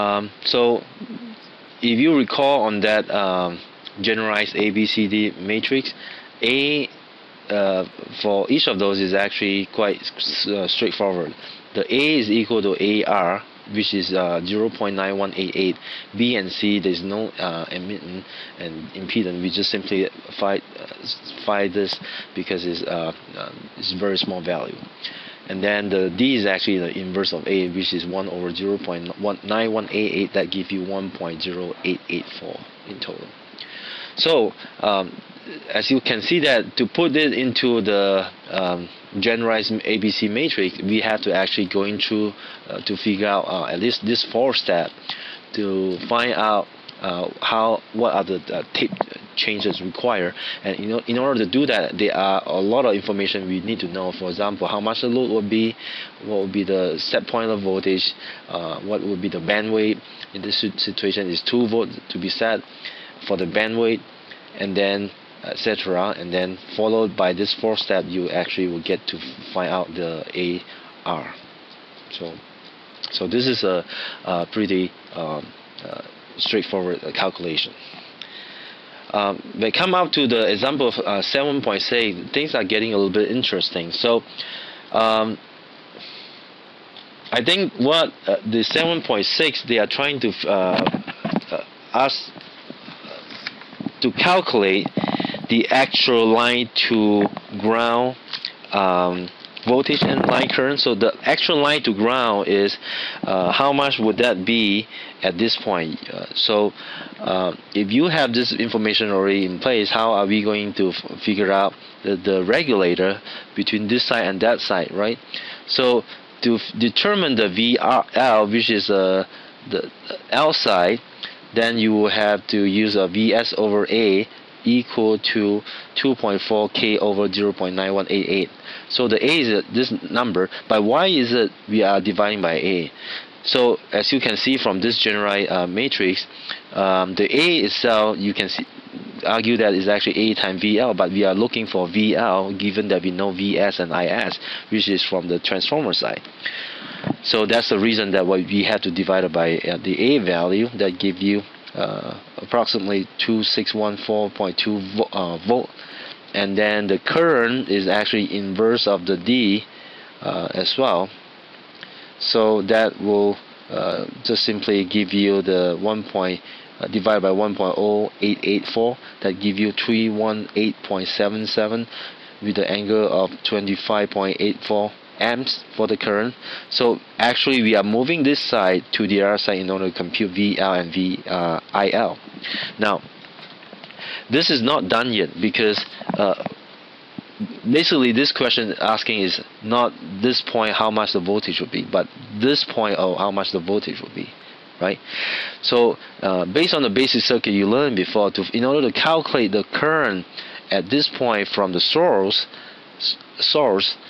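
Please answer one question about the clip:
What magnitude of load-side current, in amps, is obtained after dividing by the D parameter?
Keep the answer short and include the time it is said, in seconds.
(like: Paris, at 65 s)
318.77, at 169 s.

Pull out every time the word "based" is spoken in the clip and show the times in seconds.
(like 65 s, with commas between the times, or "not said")
196 s.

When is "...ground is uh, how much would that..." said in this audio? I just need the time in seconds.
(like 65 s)
101 s.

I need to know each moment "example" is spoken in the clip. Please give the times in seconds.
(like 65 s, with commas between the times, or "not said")
54 s, 80 s.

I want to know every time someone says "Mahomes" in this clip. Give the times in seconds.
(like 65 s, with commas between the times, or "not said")
not said.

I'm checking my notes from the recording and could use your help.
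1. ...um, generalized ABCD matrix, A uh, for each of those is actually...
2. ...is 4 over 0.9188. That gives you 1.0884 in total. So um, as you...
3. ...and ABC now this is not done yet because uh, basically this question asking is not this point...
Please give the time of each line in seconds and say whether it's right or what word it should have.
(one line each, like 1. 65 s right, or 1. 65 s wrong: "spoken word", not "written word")
1. 3 s right
2. 27 s wrong: "1", not "4"
3. 180 s wrong: "VIL", not "ABC".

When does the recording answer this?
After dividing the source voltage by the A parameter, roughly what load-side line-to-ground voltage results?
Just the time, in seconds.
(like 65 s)
153 s.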